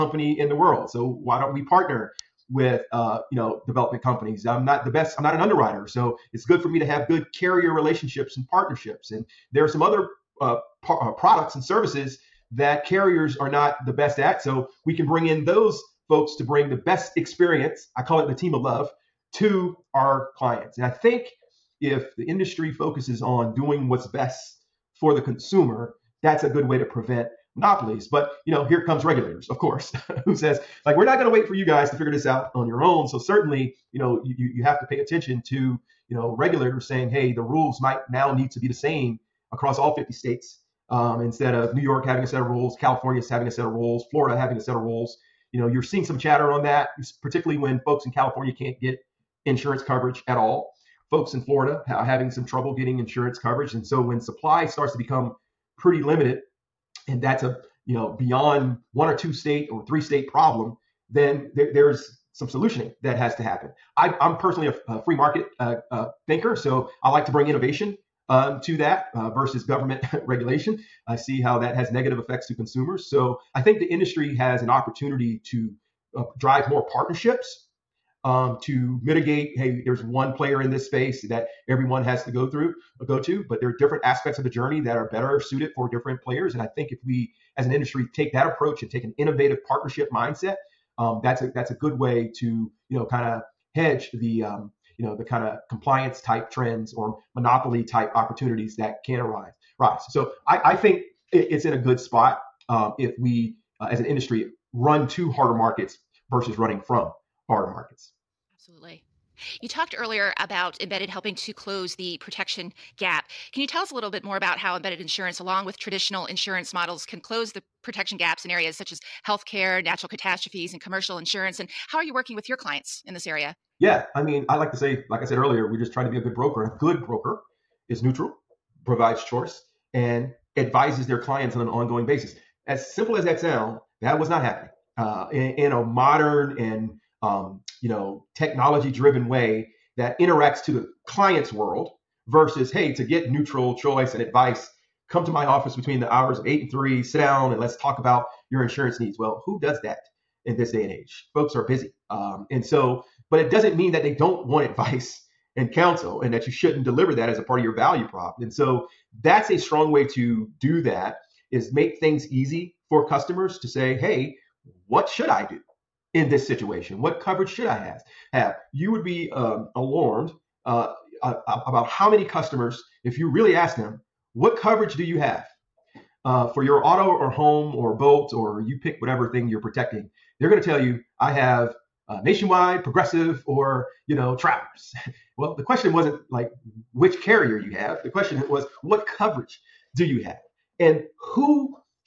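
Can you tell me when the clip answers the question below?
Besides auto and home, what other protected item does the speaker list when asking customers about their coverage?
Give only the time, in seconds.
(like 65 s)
177 s.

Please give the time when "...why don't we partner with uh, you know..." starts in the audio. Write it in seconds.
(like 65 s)
1 s.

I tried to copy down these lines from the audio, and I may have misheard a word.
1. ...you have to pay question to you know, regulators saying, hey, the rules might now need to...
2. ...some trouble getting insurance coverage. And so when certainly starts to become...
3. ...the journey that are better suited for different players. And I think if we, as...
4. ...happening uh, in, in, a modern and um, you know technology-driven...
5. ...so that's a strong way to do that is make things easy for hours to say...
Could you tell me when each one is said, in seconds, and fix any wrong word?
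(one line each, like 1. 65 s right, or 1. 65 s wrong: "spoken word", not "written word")
1. 34 s wrong: "attention", not "question"
2. 52 s wrong: "supply", not "certainly"
3. 84 s right
4. 134 s right
5. 158 s wrong: "customers", not "hours".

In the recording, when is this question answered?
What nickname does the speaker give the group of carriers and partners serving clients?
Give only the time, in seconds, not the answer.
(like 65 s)
18 s.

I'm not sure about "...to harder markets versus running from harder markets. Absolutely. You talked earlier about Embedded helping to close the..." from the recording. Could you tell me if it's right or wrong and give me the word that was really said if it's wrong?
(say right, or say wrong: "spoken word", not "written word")
right.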